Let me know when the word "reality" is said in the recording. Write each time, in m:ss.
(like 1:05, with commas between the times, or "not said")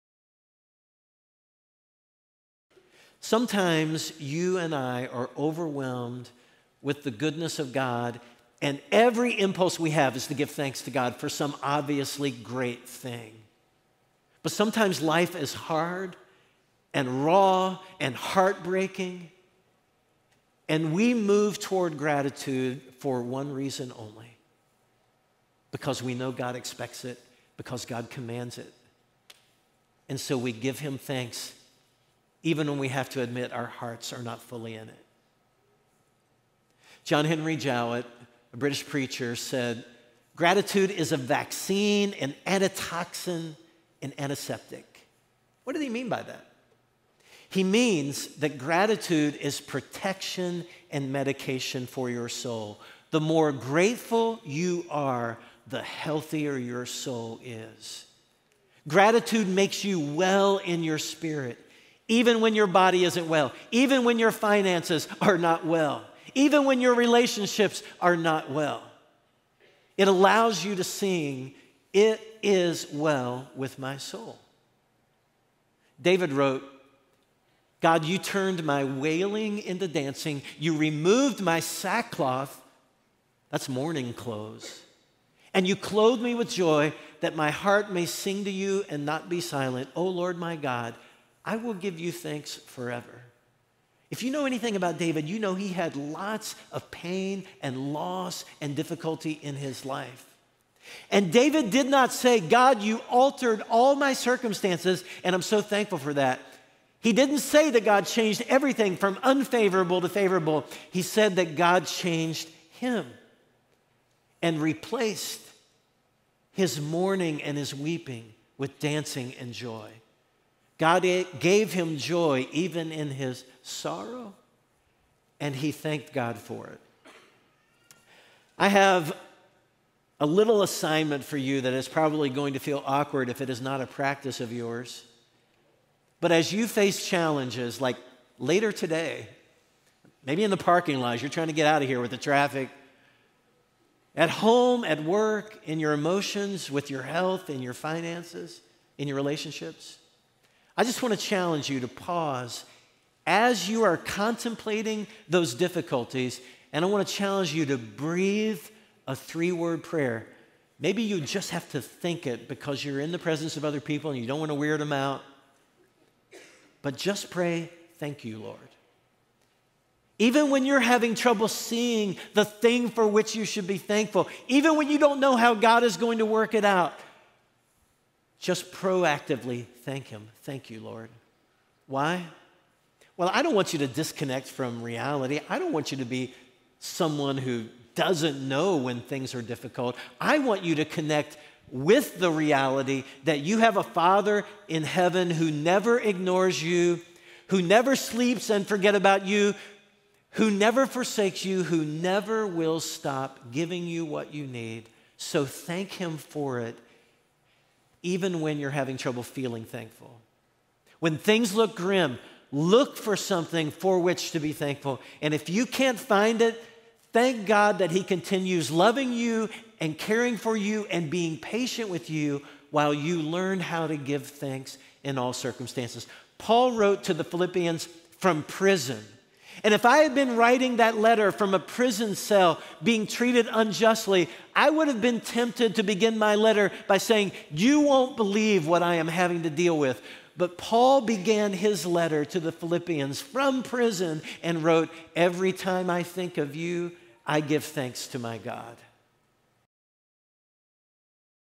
3:04, 3:12.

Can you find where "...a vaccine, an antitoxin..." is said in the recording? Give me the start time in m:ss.
0:41.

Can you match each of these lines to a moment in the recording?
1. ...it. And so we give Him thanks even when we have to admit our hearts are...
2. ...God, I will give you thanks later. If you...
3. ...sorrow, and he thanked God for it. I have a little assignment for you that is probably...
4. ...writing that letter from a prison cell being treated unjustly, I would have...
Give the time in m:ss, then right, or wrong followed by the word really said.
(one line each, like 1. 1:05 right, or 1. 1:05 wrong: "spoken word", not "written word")
1. 0:28 right
2. 1:30 wrong: "forever", not "later"
3. 2:03 right
4. 3:50 right.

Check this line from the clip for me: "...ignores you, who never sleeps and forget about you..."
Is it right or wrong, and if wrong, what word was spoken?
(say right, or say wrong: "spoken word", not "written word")
right.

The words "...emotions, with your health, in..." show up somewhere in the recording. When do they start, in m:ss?
2:25.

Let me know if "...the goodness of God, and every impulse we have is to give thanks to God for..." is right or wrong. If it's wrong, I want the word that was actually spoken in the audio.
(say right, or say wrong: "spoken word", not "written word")
right.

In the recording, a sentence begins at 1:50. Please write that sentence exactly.
He said that God changed him and replaced his mourning and his weeping with dancing and joy.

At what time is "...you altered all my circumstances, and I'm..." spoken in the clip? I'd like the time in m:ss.
1:42.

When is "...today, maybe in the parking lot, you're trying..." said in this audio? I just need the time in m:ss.
2:18.